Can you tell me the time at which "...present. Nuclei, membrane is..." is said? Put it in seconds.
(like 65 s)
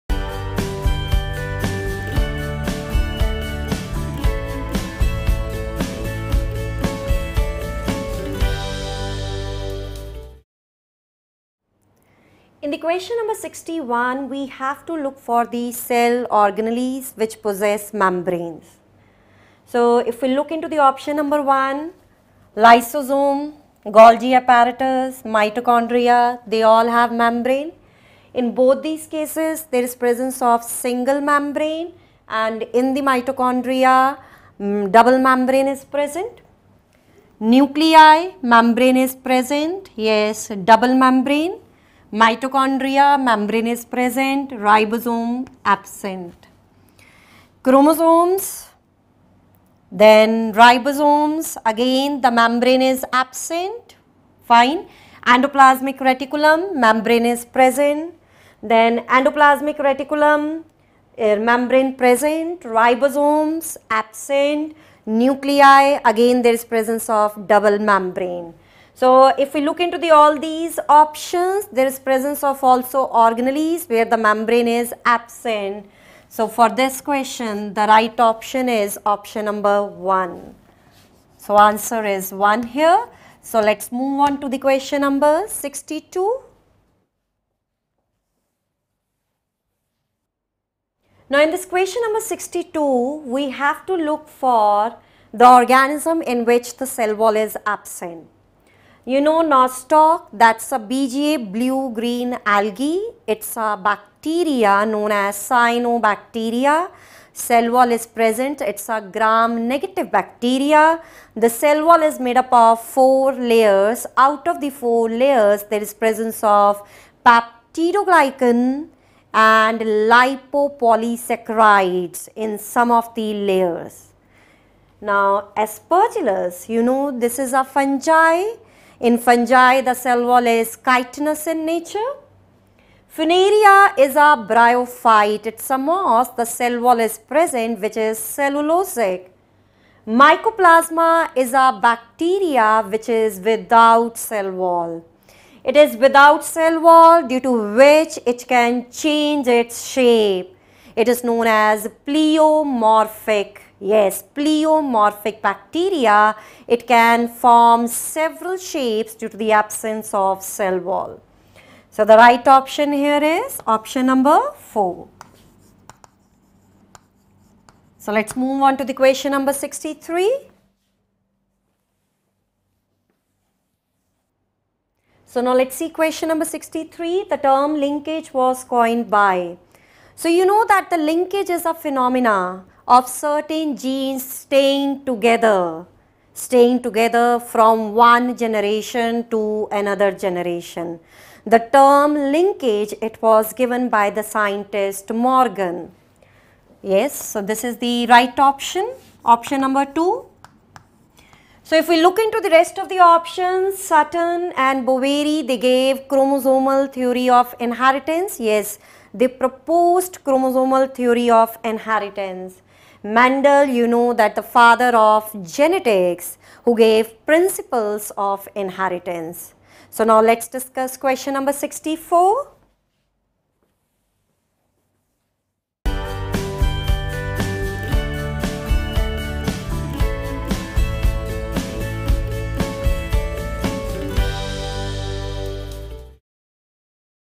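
35 s.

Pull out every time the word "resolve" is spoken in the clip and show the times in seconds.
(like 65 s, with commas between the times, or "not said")
not said.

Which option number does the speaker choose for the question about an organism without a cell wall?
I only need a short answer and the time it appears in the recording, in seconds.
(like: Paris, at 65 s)
4, at 163 s.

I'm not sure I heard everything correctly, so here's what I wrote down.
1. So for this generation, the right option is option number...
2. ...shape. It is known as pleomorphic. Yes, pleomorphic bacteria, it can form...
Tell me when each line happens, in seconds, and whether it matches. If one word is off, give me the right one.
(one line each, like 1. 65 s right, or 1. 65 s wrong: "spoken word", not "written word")
1. 76 s wrong: "question", not "generation"
2. 149 s right.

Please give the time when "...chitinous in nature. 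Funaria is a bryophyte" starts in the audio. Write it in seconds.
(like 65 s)
130 s.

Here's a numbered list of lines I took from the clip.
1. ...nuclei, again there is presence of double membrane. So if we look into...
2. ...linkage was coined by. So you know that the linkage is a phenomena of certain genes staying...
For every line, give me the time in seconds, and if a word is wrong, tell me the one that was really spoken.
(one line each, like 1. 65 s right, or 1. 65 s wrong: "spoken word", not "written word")
1. 65 s right
2. 177 s right.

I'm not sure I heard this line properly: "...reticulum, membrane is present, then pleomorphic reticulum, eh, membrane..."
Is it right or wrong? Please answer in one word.
wrong.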